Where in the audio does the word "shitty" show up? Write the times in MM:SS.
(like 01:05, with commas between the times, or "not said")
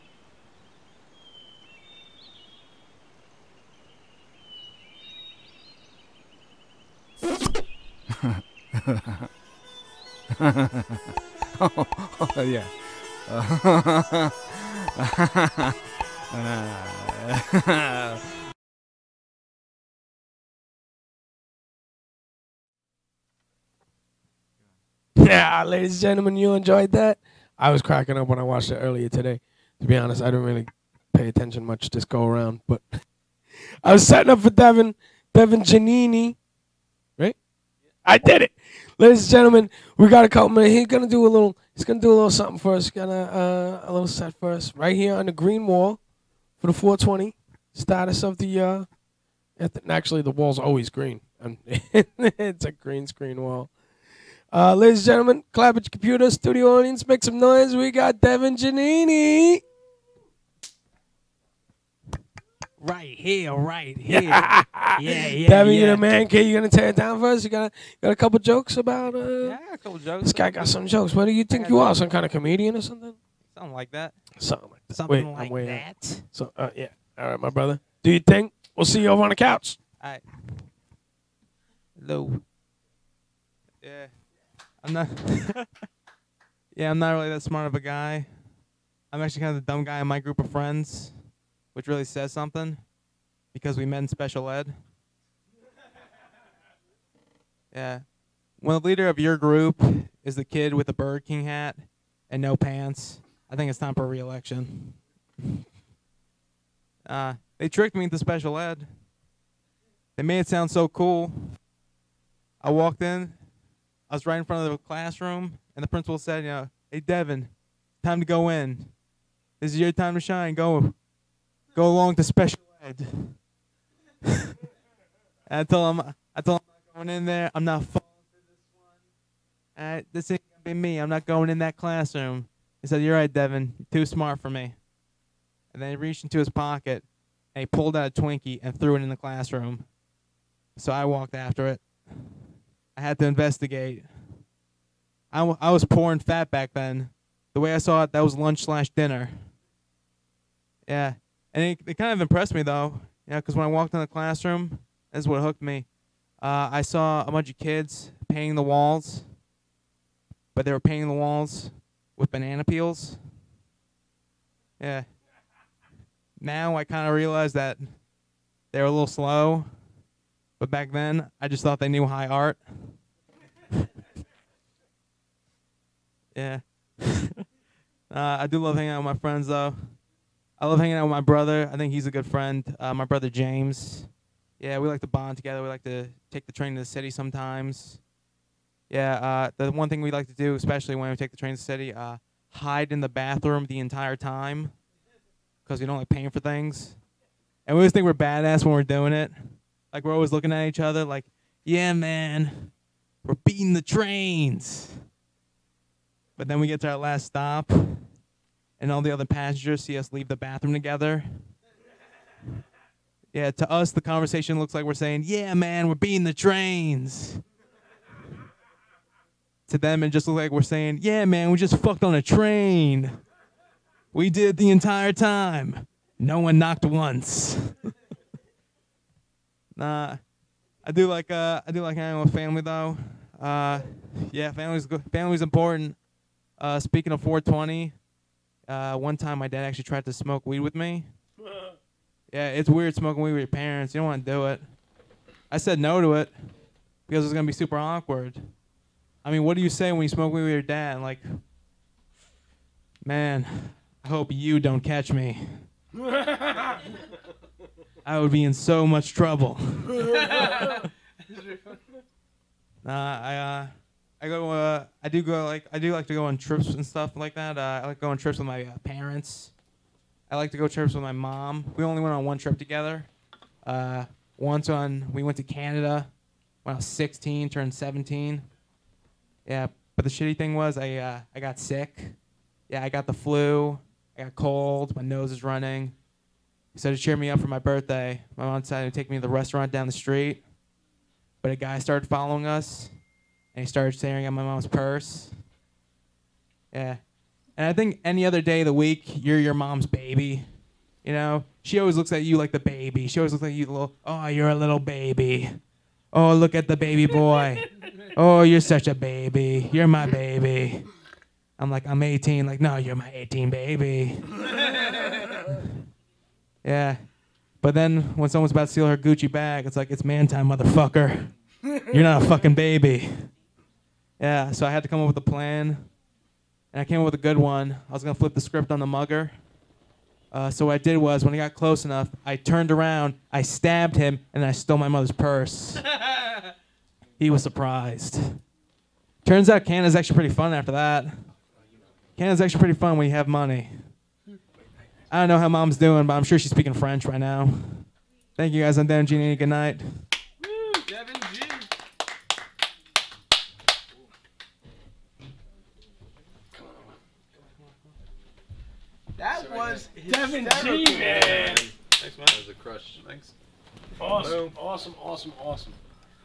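04:40.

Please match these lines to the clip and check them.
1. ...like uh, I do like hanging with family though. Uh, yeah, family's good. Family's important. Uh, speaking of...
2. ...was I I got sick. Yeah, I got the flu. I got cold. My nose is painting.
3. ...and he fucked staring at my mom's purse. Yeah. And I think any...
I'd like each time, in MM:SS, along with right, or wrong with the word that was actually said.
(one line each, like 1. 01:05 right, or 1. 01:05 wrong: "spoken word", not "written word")
1. 03:51 right
2. 04:40 wrong: "running", not "painting"
3. 04:53 wrong: "started", not "fucked".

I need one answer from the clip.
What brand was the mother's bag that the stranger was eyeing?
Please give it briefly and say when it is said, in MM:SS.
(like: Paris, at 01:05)
Gucci, at 05:18.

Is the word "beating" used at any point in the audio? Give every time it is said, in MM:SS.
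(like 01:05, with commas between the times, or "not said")
03:23, 03:35.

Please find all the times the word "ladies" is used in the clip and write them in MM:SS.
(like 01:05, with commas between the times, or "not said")
00:25, 00:38, 00:54.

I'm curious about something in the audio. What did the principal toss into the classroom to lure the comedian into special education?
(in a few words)
Twinkie.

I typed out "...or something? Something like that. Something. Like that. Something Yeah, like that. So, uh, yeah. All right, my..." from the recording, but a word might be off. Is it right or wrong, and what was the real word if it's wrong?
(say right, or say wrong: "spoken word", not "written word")
wrong: "Wait", not "Yeah".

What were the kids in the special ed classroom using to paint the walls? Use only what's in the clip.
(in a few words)
banana peels.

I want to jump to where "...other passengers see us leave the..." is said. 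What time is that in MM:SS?
03:29.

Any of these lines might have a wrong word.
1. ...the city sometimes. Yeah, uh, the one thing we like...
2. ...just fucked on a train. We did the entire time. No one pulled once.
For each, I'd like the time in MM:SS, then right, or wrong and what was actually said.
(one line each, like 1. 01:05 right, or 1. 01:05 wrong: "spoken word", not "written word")
1. 03:06 right
2. 03:41 wrong: "knocked", not "pulled".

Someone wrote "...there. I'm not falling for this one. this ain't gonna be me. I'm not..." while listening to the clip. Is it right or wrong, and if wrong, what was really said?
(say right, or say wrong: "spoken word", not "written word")
right.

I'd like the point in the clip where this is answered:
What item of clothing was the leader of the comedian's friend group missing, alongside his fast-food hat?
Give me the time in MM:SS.
01:42.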